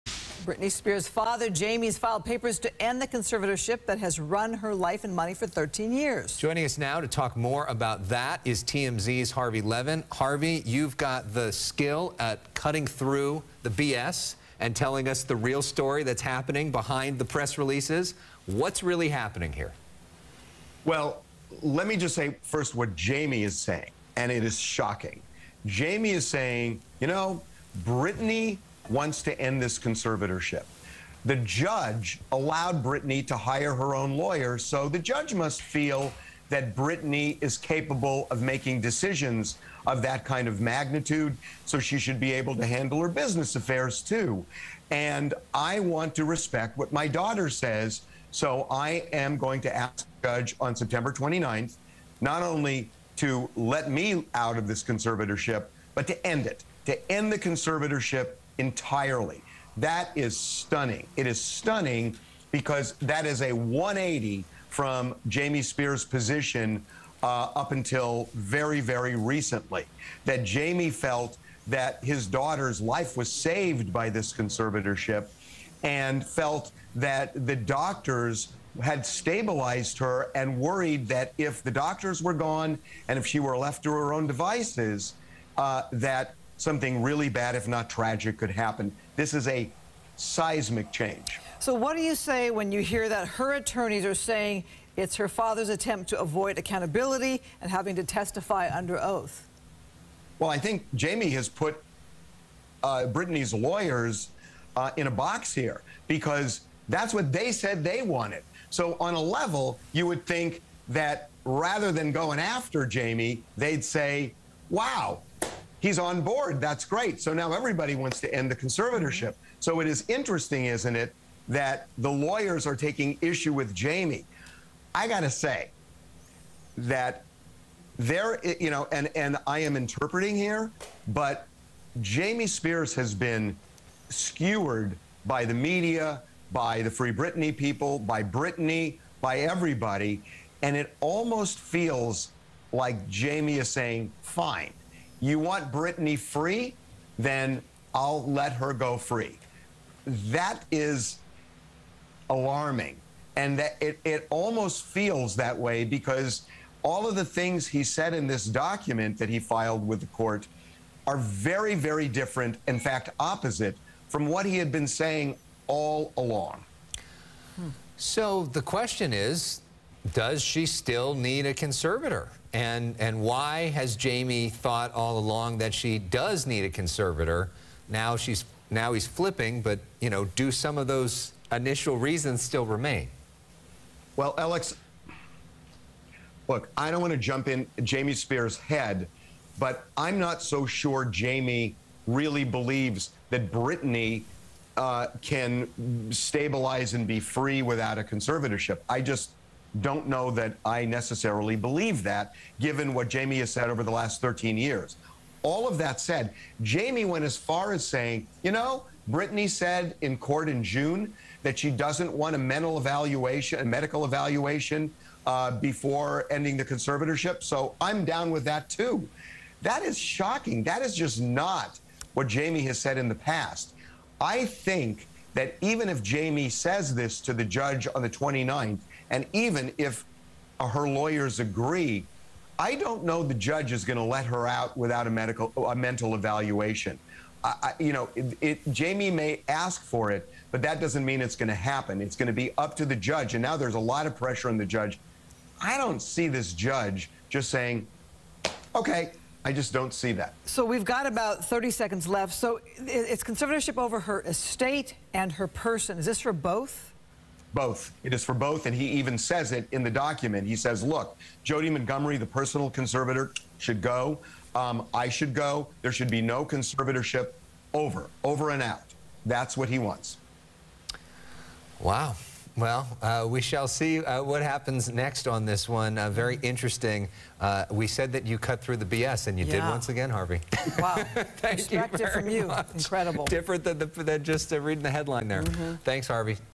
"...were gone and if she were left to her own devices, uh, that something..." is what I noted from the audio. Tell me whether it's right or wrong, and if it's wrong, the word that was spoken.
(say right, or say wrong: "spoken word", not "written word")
right.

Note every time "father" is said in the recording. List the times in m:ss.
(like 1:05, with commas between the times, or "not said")
0:01, 1:35.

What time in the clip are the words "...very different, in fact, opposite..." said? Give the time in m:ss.
2:41.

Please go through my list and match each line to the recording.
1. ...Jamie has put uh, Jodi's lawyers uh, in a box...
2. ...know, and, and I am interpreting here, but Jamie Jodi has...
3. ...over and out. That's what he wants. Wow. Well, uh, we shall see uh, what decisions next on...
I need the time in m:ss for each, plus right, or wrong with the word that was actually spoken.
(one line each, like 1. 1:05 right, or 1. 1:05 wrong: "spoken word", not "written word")
1. 1:40 wrong: "Britney", not "Jodi"
2. 2:08 wrong: "Spears", not "Jodi"
3. 4:28 wrong: "happens", not "decisions".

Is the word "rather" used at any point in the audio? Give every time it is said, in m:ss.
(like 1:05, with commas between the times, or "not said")
1:51.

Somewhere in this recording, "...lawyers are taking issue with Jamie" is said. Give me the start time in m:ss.
2:02.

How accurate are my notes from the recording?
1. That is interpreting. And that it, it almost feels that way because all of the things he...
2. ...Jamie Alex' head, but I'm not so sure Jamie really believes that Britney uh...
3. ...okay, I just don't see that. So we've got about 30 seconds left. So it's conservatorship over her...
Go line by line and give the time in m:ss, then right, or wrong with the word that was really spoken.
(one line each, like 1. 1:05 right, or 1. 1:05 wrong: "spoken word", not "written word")
1. 2:30 wrong: "alarming", not "interpreting"
2. 3:07 wrong: "Spears", not "Alex"
3. 4:08 right.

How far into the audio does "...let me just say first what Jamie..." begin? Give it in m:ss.
0:21.